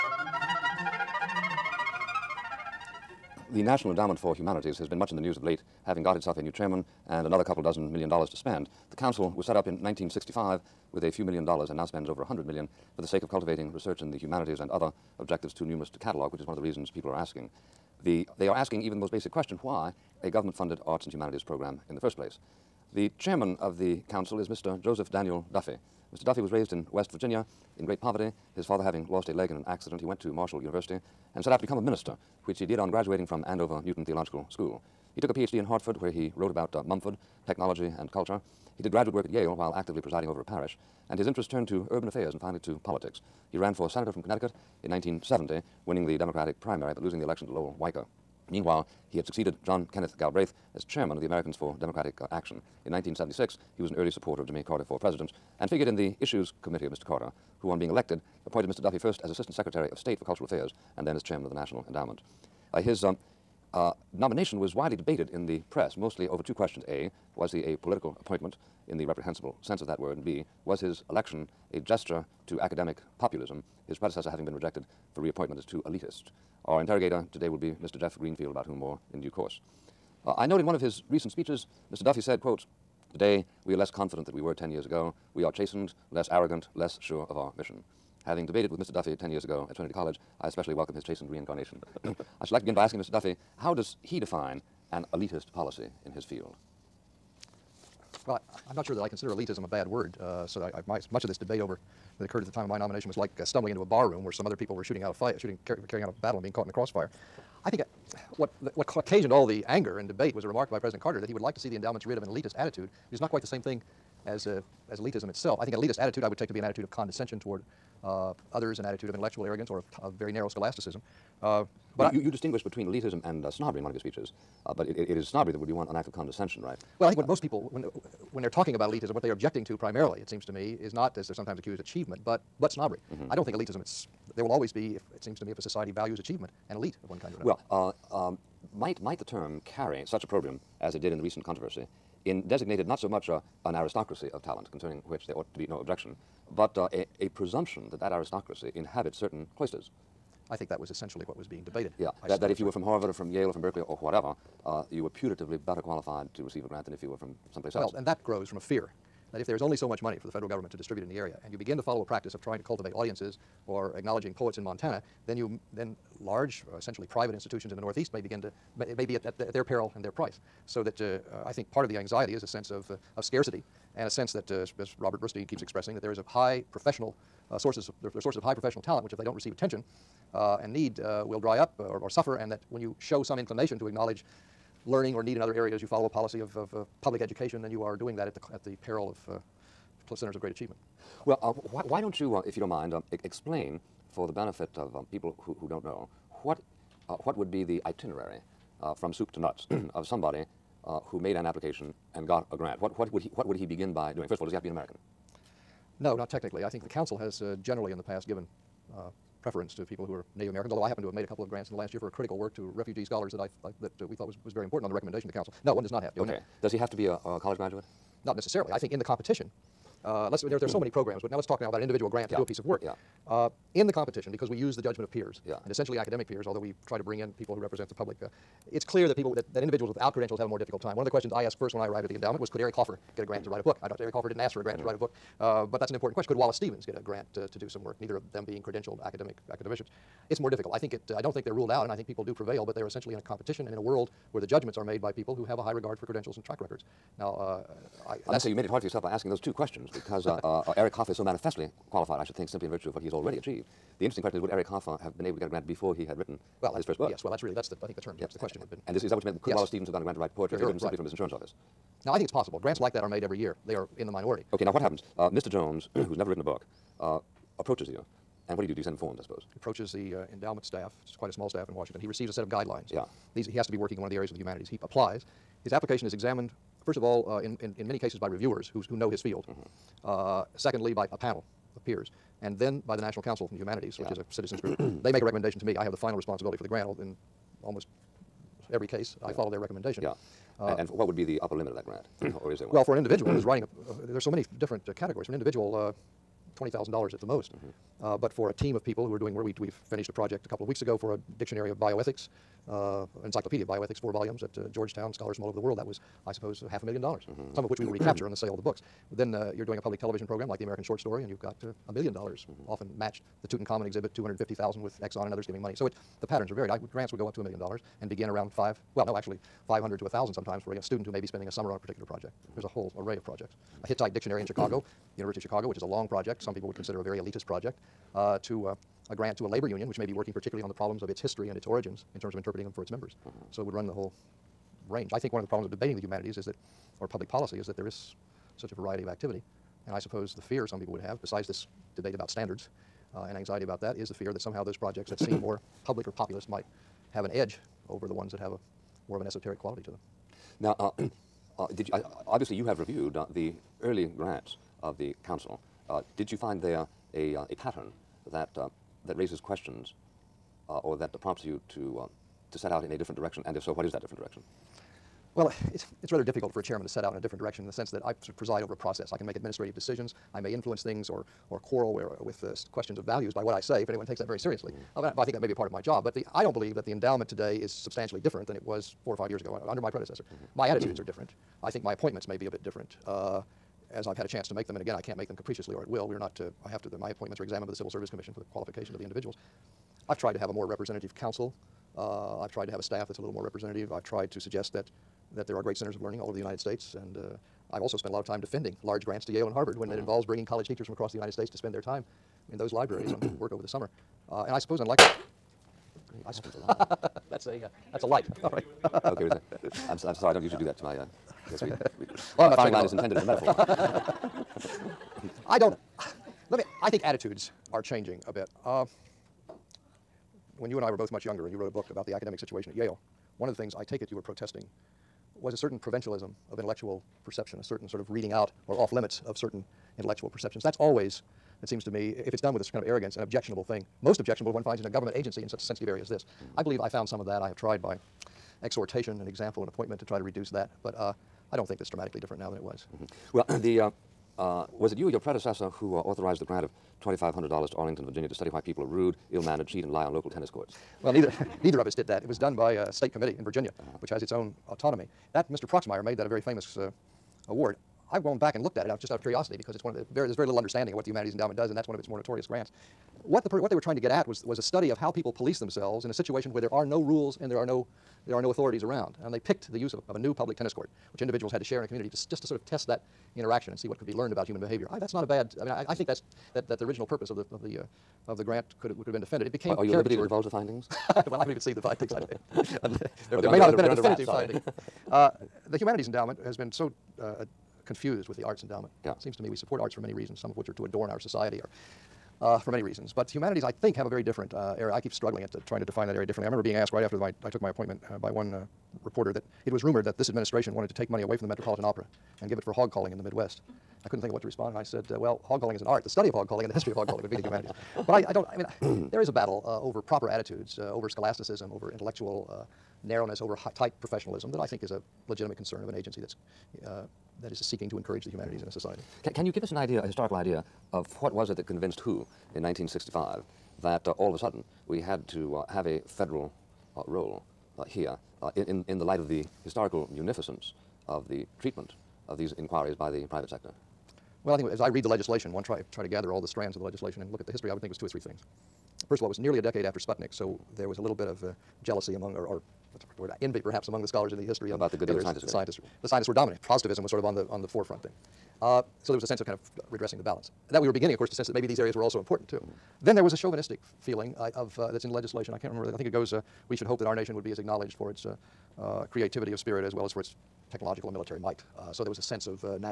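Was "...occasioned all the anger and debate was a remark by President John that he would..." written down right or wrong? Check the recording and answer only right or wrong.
wrong.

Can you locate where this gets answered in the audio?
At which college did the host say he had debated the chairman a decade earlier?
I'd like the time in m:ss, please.
1:29.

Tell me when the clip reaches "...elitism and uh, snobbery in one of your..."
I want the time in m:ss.
2:02.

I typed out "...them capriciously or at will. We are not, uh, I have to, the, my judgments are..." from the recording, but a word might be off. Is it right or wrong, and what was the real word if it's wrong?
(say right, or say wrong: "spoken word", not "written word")
wrong: "appointments", not "judgments".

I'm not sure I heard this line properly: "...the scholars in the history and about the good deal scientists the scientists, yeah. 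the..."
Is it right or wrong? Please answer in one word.
right.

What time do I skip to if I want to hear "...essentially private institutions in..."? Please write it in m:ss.
2:46.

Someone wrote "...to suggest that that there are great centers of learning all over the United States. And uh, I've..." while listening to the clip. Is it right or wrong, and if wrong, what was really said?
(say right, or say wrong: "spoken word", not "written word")
right.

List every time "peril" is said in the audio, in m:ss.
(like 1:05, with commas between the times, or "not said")
2:49, 3:08.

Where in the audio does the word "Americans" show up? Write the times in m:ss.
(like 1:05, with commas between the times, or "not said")
0:51, 3:24, 3:30, 5:10.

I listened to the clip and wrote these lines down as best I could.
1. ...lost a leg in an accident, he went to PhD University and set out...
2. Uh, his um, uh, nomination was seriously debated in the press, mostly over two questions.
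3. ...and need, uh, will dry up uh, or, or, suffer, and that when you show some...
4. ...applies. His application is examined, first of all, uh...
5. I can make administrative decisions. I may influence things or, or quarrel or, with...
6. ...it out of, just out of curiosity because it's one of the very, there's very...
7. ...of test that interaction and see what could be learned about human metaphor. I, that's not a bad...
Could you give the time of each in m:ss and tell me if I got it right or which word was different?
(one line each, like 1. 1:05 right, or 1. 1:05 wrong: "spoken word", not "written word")
1. 0:29 wrong: "Marshall", not "PhD"
2. 1:02 wrong: "widely", not "seriously"
3. 3:00 right
4. 4:34 right
5. 6:09 right
6. 7:38 right
7. 7:52 wrong: "behavior", not "metaphor".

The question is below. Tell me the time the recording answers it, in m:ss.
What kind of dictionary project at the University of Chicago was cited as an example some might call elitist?
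5:23.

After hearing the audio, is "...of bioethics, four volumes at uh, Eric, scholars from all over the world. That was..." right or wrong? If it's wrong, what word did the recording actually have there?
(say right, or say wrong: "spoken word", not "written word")
wrong: "Georgetown", not "Eric".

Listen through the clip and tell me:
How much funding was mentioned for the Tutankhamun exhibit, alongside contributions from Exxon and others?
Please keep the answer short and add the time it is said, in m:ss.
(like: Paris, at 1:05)
250,000, at 5:14.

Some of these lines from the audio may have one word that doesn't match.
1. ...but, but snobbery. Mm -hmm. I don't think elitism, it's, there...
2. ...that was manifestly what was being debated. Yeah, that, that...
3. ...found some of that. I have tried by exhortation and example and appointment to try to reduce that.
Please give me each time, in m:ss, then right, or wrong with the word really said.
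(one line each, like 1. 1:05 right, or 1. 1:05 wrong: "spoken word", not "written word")
1. 2:12 right
2. 2:30 wrong: "essentially", not "manifestly"
3. 7:16 right.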